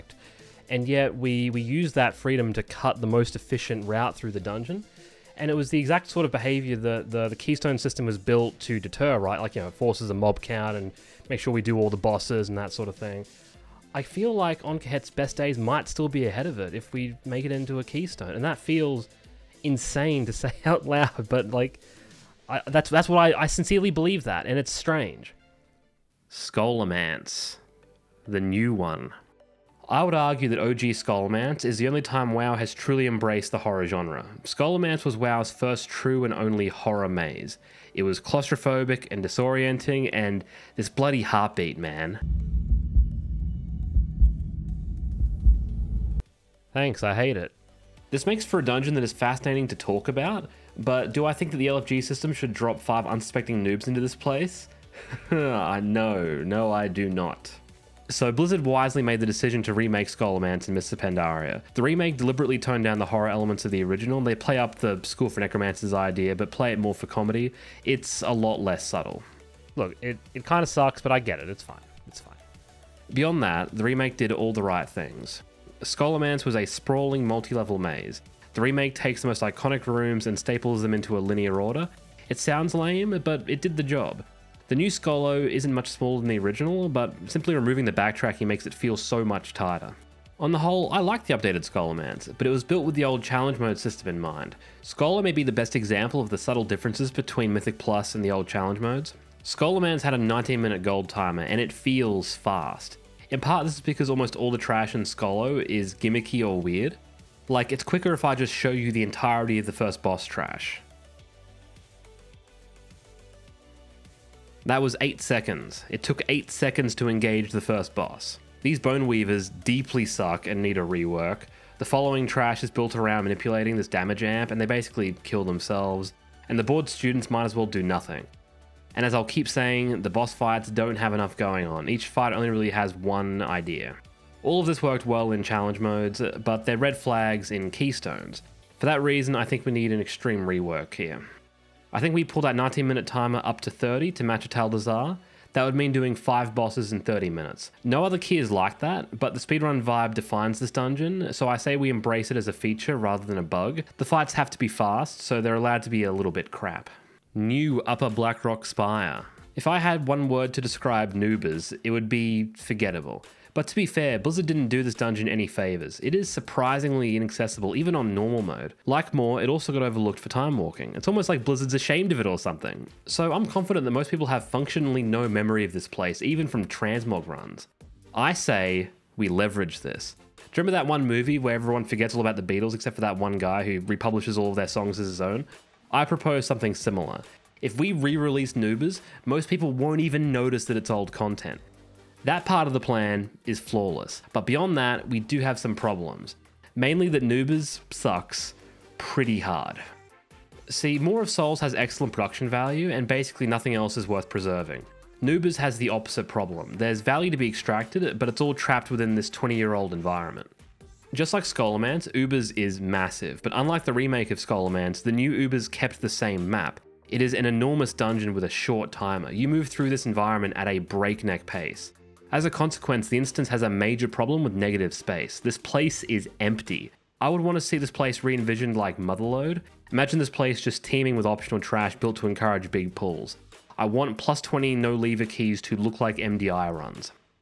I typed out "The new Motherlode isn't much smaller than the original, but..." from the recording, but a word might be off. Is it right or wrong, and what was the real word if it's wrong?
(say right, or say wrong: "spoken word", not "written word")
wrong: "Scholo", not "Motherlode".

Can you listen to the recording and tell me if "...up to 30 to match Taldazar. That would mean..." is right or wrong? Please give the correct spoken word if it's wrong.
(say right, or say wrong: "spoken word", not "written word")
right.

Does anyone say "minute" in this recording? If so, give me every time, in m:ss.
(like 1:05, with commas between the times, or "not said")
1:40, 2:22, 2:27.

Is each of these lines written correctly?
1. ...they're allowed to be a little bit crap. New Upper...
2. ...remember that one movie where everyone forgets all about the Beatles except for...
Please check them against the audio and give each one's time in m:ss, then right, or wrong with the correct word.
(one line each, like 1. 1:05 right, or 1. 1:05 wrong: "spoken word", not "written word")
1. 2:35 right
2. 3:00 right.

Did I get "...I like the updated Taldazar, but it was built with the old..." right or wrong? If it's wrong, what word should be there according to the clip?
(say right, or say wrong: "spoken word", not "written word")
wrong: "Scholomance", not "Taldazar".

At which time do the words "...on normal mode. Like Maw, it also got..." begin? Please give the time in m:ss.
2:47.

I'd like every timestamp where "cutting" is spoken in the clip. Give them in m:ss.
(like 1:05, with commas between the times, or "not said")
not said.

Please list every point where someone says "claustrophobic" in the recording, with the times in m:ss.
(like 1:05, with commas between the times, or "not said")
0:38.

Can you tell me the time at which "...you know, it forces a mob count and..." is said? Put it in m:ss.
0:09.